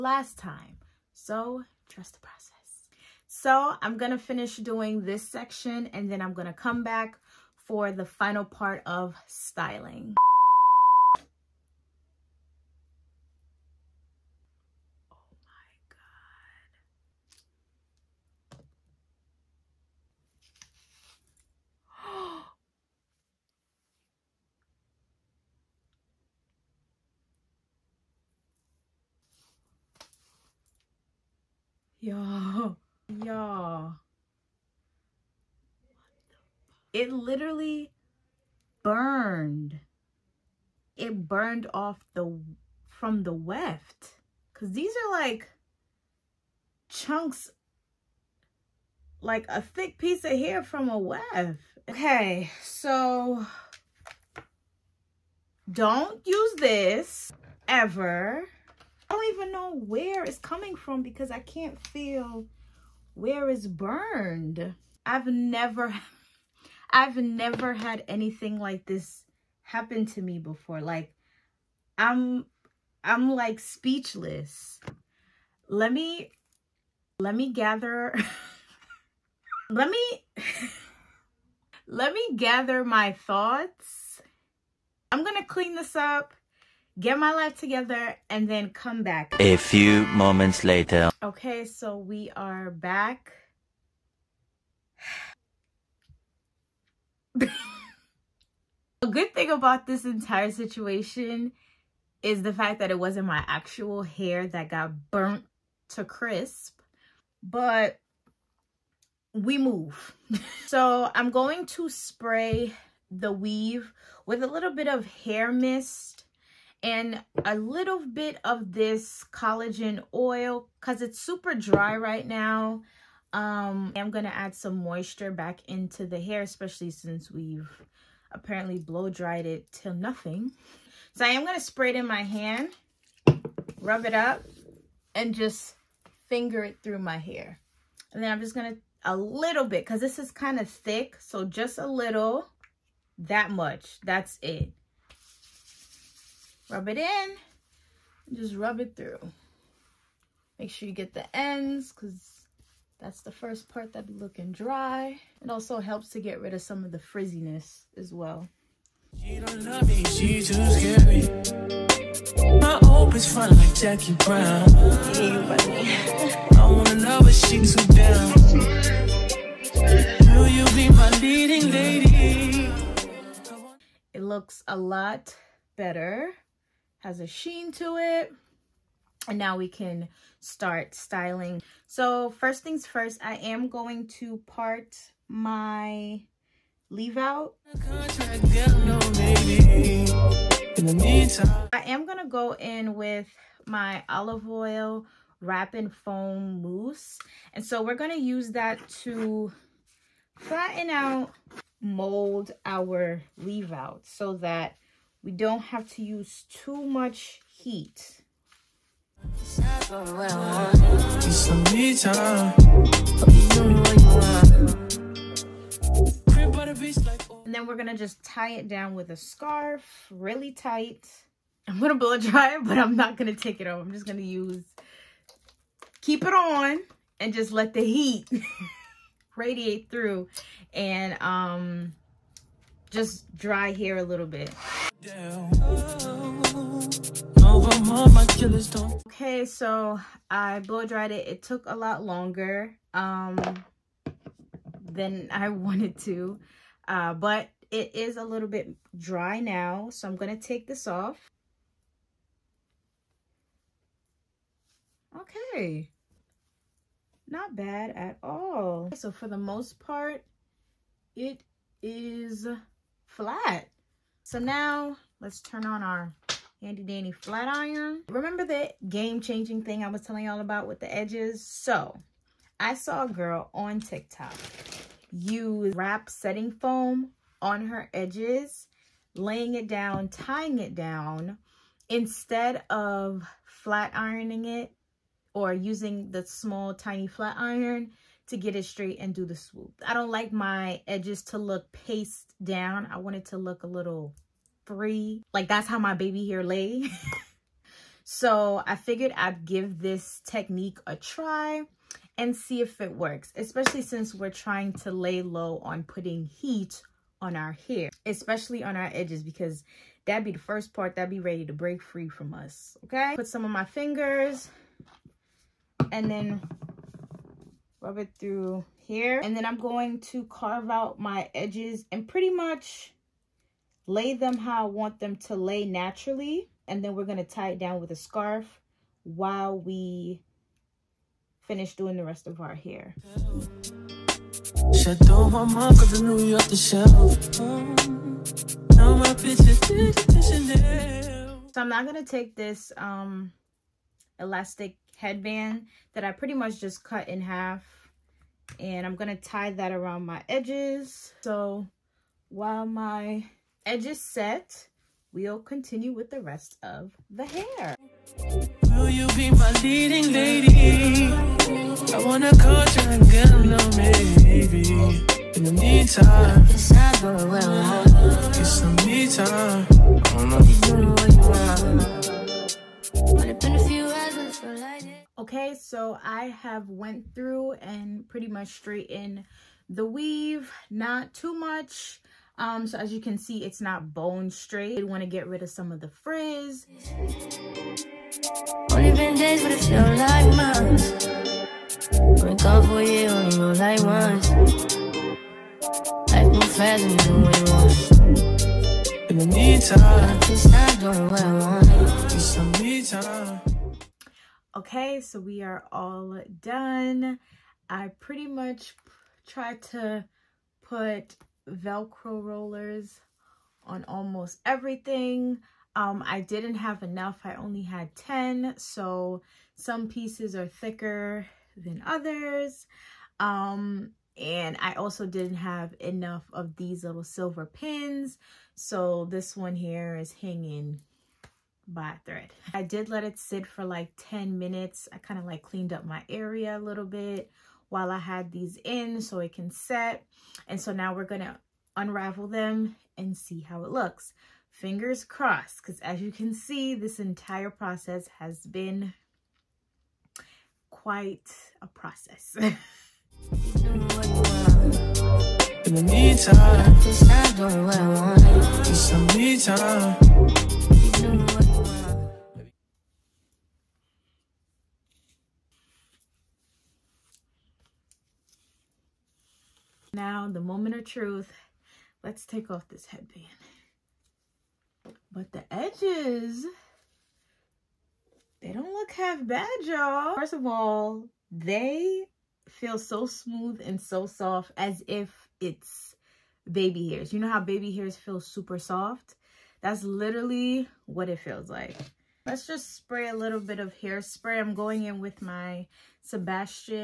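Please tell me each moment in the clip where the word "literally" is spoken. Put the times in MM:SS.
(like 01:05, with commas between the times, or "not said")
00:37, 08:09.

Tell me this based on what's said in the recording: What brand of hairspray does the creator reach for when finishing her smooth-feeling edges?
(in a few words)
Sebastian.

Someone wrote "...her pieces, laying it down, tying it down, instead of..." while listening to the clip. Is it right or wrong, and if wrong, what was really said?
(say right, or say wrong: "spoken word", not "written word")
wrong: "edges", not "pieces".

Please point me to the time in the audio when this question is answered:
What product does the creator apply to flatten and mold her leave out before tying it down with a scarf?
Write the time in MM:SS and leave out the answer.
03:14.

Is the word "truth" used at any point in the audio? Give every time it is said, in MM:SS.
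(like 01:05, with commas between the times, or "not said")
07:50.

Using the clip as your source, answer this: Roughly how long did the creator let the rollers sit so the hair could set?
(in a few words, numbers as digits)
10 minutes.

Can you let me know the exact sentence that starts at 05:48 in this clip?
And I'm going to tie that around my edges.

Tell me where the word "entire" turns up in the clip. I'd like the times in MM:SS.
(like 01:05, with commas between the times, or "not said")
01:40, 07:26.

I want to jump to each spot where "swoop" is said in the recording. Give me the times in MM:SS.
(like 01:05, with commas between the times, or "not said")
04:49.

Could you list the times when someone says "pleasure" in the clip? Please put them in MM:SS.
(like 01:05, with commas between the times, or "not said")
not said.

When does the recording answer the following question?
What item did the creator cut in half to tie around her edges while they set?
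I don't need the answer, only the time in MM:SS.
05:44.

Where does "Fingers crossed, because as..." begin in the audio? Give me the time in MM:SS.
07:24.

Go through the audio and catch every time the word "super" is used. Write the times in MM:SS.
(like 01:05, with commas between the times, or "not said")
02:01, 08:08.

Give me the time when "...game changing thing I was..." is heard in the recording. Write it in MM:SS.
04:28.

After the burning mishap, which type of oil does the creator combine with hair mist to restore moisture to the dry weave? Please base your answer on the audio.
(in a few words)
collagen oil.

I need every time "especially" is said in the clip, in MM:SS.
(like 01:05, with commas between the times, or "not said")
02:06, 05:03, 05:08.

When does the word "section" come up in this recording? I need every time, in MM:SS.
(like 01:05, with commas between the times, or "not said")
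00:05.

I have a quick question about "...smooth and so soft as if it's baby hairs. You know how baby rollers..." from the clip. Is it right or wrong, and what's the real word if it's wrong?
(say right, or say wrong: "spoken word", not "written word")
wrong: "hairs", not "rollers".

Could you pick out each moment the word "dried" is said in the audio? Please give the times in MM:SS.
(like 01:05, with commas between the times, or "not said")
02:09, 04:00.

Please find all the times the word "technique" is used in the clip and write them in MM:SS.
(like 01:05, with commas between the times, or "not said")
05:00.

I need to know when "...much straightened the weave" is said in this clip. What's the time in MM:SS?
06:18.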